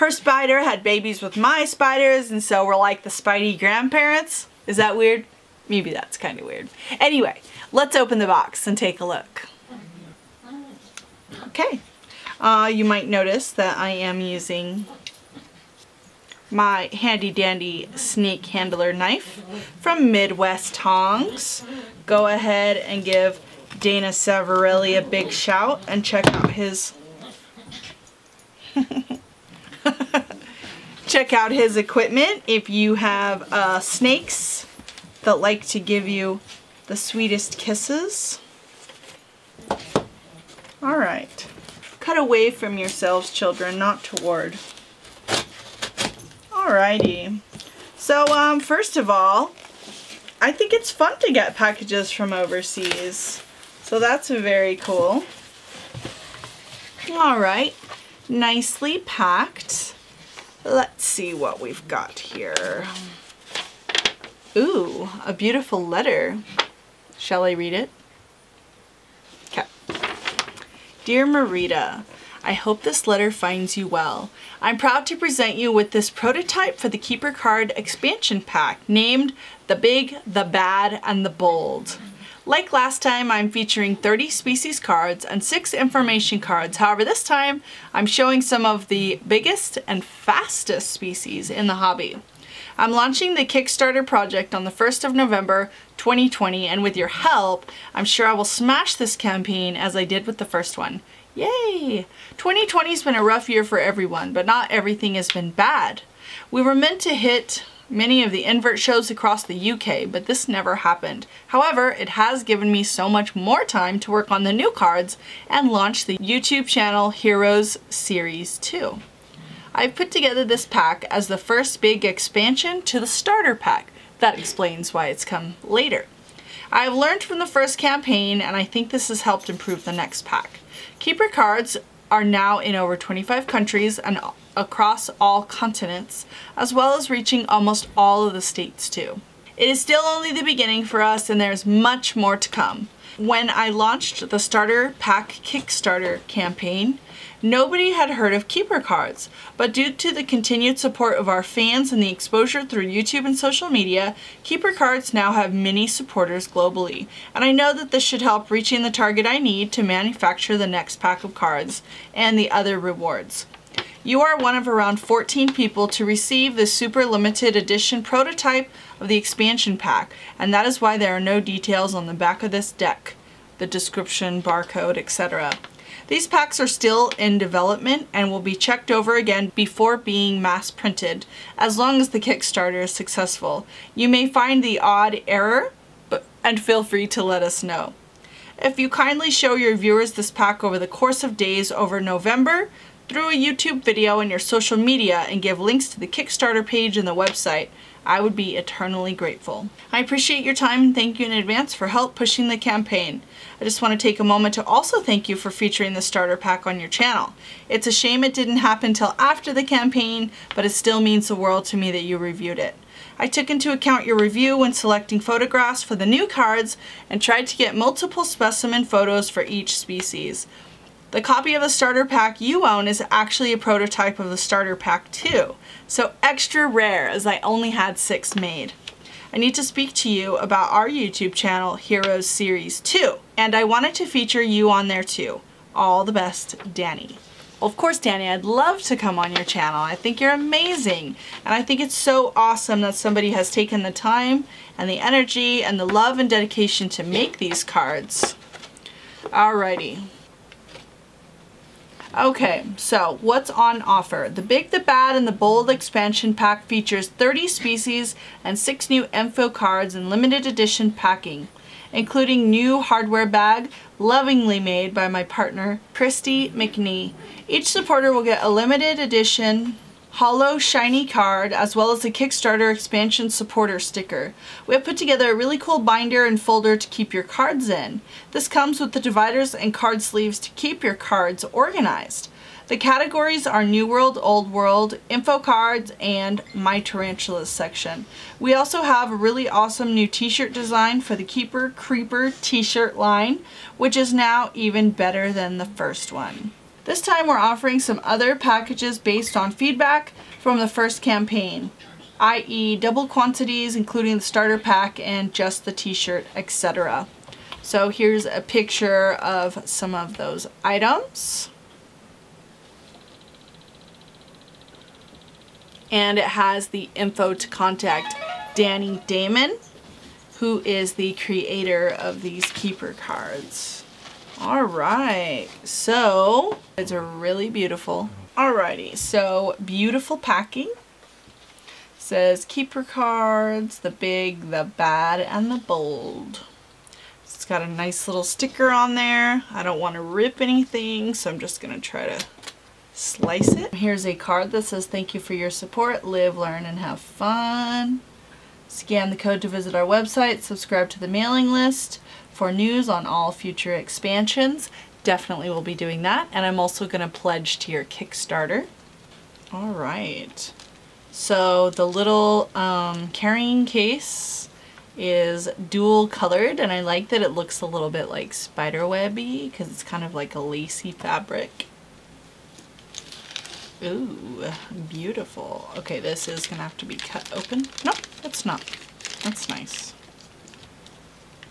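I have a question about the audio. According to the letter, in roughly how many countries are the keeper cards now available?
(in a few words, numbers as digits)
25.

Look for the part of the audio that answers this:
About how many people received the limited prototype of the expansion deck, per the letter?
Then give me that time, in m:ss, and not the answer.
2:44.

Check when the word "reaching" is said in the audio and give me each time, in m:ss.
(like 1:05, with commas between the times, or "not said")
2:17, 2:38.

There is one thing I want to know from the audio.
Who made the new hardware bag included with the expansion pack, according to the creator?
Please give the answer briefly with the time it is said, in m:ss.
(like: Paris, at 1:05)
Christy McNee, at 4:25.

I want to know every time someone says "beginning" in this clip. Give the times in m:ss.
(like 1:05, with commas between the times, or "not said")
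2:20.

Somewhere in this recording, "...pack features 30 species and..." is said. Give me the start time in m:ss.
4:16.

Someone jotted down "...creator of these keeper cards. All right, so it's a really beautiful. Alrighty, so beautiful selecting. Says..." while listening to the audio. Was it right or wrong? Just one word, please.
wrong.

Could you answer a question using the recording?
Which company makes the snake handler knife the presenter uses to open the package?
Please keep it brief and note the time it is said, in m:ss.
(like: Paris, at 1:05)
Midwest Tongs, at 0:20.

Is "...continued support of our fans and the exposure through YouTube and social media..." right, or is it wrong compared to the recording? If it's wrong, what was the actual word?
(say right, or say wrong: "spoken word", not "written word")
right.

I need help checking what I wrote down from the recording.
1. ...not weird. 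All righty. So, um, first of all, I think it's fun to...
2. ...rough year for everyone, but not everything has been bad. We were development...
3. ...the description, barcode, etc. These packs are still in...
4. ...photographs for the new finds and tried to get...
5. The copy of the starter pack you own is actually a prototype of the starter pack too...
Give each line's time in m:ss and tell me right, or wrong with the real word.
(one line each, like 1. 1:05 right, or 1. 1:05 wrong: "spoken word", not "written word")
1. 0:43 wrong: "toward", not "weird"
2. 1:43 wrong: "meant", not "development"
3. 2:53 right
4. 3:35 wrong: "cards", not "finds"
5. 3:41 right.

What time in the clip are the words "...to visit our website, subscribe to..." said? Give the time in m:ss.
5:49.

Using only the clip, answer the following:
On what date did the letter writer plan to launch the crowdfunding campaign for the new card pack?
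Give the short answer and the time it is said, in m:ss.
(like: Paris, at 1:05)
1st of November 2020, at 1:34.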